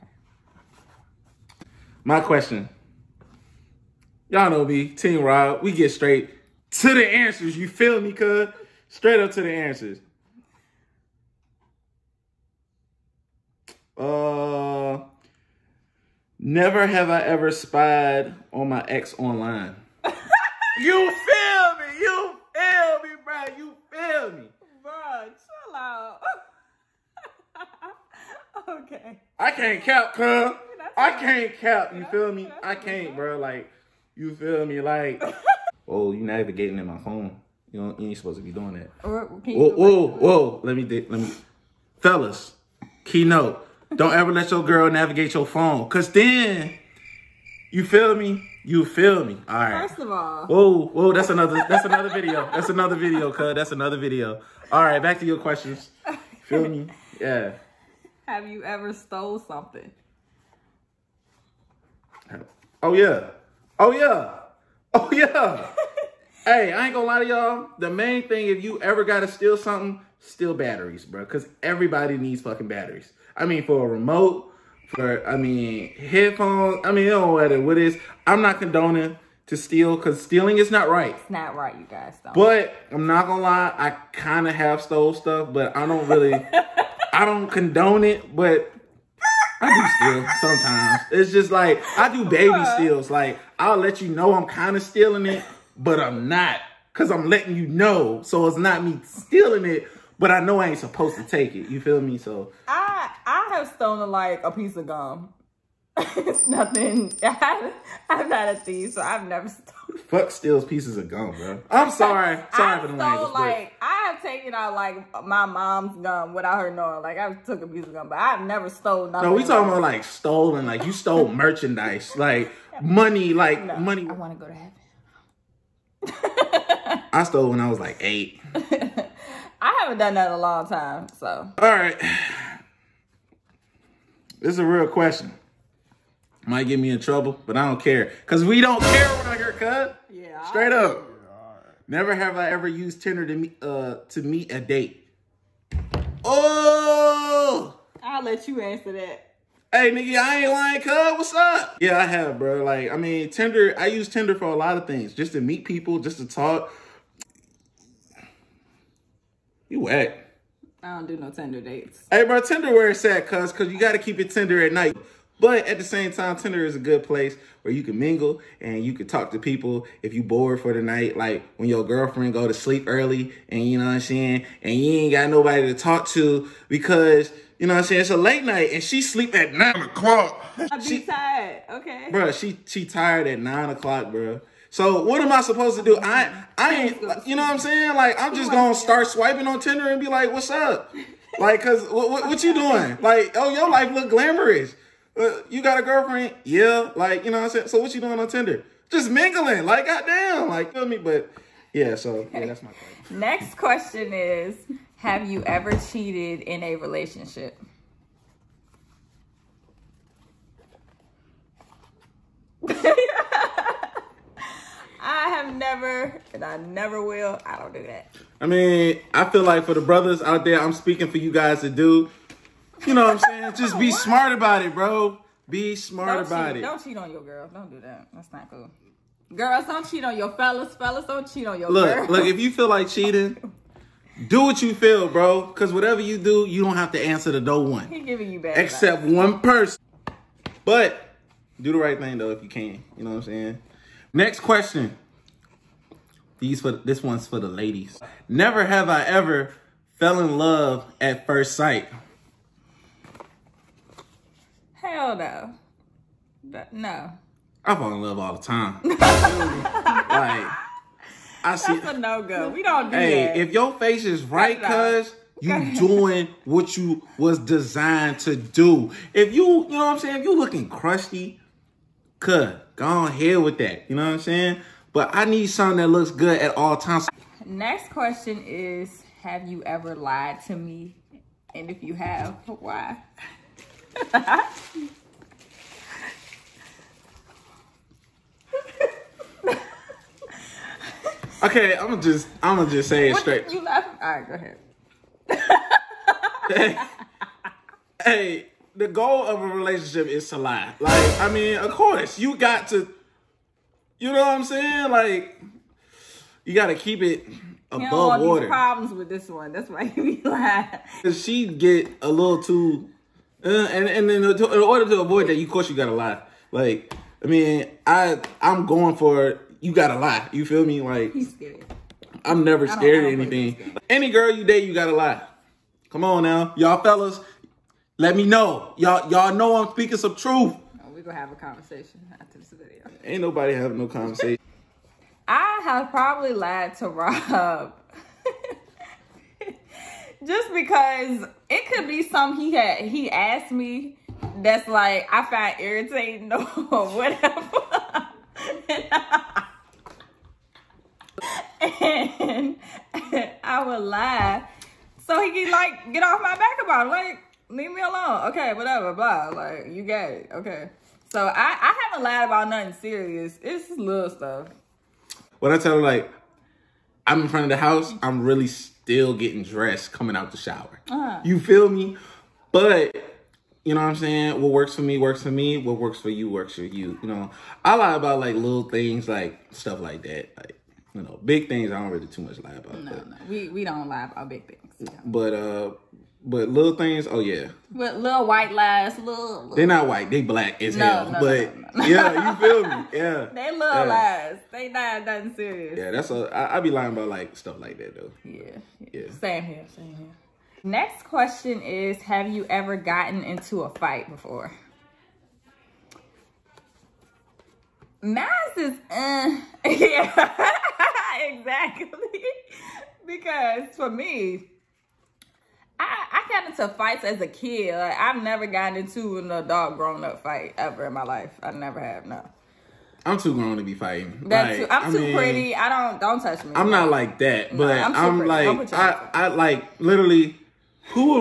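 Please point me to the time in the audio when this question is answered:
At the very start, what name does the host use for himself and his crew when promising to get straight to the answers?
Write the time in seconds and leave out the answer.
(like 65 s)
4 s.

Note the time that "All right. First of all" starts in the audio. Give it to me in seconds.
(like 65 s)
49 s.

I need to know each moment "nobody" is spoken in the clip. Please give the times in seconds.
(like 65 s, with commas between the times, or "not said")
175 s, 333 s.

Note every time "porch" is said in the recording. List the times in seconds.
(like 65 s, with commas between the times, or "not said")
not said.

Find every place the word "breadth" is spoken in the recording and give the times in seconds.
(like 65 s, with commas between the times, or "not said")
not said.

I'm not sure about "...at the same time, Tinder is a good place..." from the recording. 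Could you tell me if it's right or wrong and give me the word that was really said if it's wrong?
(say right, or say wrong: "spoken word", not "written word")
right.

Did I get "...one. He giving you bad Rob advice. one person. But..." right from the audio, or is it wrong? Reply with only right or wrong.
wrong.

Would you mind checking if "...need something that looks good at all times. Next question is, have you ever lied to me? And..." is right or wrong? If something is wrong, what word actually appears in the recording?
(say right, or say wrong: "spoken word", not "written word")
right.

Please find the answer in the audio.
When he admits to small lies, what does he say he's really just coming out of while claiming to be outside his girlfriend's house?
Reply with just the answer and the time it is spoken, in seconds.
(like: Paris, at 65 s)
The shower, at 370 s.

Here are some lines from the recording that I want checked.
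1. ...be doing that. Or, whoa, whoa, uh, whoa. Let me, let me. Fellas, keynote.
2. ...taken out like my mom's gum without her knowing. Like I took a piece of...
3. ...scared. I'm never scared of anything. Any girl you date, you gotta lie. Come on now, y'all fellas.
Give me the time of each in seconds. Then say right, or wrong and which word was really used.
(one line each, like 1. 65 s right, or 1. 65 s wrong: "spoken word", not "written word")
1. 38 s right
2. 114 s right
3. 321 s right.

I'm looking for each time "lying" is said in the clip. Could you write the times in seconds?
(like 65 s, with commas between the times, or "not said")
150 s, 396 s.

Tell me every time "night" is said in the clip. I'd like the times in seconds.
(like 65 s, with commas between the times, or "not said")
164 s, 170 s, 178 s.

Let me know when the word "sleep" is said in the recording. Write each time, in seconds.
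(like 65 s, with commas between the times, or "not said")
172 s, 179 s.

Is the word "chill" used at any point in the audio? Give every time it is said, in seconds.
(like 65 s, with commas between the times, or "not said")
25 s.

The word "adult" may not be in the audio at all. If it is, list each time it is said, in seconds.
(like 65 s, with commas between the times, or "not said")
419 s.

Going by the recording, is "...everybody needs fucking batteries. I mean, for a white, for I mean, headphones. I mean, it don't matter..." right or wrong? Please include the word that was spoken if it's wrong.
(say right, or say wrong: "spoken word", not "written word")
wrong: "remote", not "white".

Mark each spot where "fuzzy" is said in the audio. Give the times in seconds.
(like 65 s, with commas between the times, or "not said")
not said.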